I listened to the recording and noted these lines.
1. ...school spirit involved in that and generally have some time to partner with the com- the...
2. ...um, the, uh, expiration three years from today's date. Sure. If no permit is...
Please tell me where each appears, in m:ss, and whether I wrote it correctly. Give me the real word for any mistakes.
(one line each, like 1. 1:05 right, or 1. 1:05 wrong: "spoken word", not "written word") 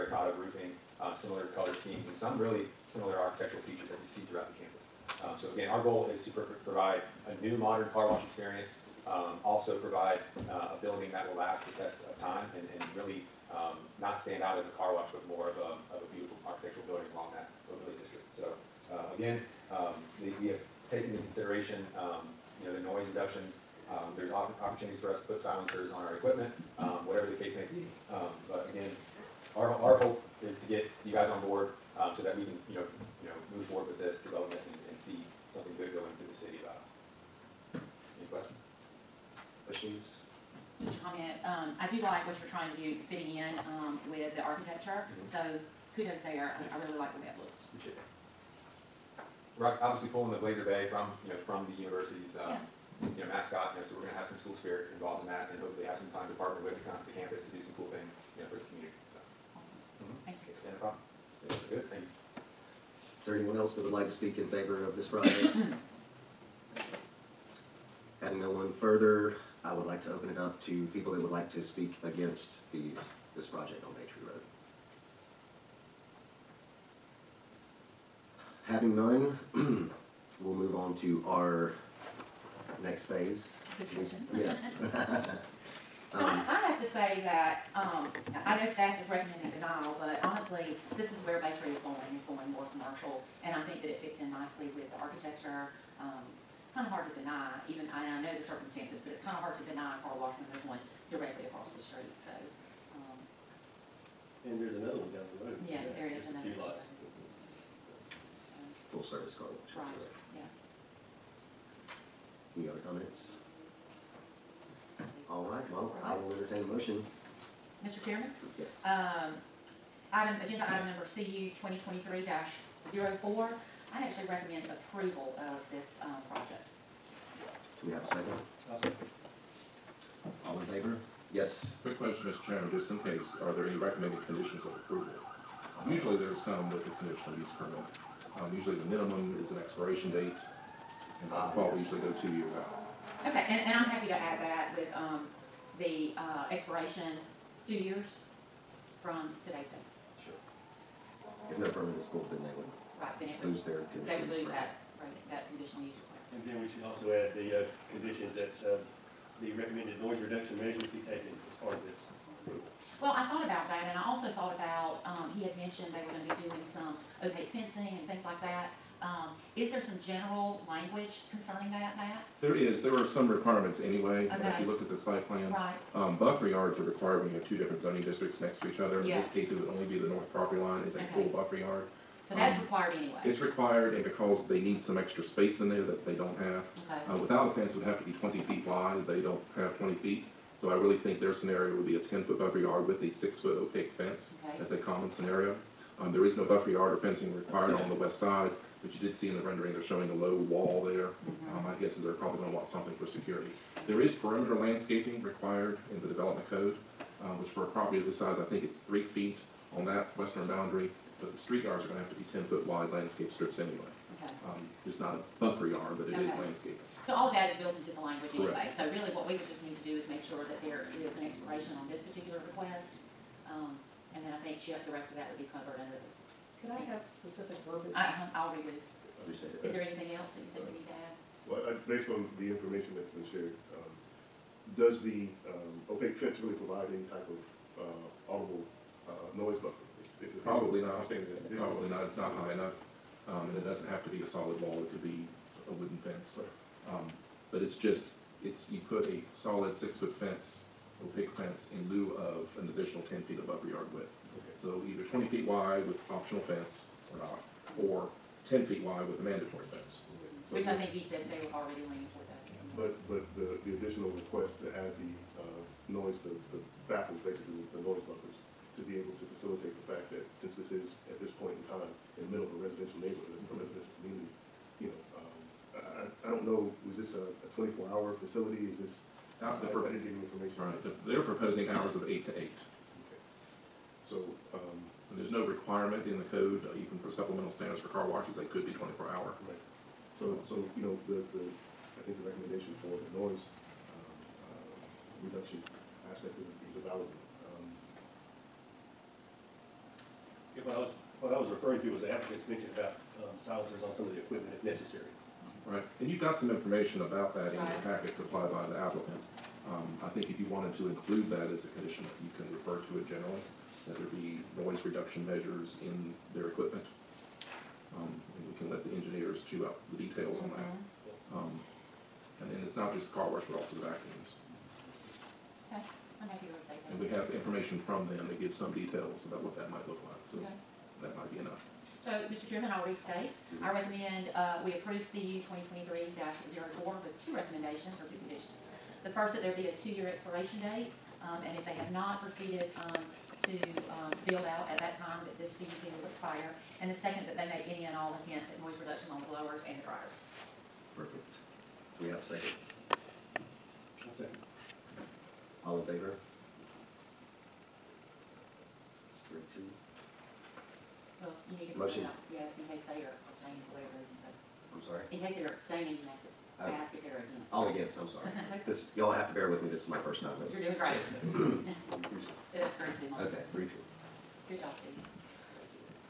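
1. 0:54 wrong: "hopefully", not "generally"
2. 2:24 wrong: "two", not "three".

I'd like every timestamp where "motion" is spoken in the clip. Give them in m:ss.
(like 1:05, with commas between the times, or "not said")
1:56, 6:01.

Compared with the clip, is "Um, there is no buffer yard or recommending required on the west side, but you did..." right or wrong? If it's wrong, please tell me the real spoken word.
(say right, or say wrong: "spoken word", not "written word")
wrong: "fencing", not "recommending".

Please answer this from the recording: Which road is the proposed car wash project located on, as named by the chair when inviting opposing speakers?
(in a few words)
Bay Tree Road.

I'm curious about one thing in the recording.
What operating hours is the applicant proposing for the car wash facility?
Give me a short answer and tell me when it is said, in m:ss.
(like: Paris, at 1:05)
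8 to 8, at 4:42.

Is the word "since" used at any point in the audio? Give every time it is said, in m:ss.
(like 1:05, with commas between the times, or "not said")
4:30.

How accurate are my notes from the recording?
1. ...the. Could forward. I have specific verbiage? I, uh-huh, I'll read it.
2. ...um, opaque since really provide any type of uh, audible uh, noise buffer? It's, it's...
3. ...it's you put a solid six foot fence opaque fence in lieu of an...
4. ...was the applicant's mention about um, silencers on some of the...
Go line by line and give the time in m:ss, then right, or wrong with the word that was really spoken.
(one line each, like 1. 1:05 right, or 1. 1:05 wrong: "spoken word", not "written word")
1. 3:45 wrong: "standard", not "forward"
2. 3:55 wrong: "fence", not "since"
3. 4:08 right
4. 5:01 right.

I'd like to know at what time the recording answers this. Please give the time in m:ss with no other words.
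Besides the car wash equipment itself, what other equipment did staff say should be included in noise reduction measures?
5:23.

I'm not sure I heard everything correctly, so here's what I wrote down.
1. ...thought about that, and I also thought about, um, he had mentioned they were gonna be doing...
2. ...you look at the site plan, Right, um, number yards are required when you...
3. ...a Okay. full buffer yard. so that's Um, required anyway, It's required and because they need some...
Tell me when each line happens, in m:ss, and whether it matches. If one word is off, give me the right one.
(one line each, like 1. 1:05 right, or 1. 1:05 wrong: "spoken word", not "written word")
1. 2:43 right
2. 2:54 wrong: "buffer", not "number"
3. 3:00 right.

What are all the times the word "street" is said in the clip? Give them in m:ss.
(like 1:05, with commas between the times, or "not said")
1:41, 3:31.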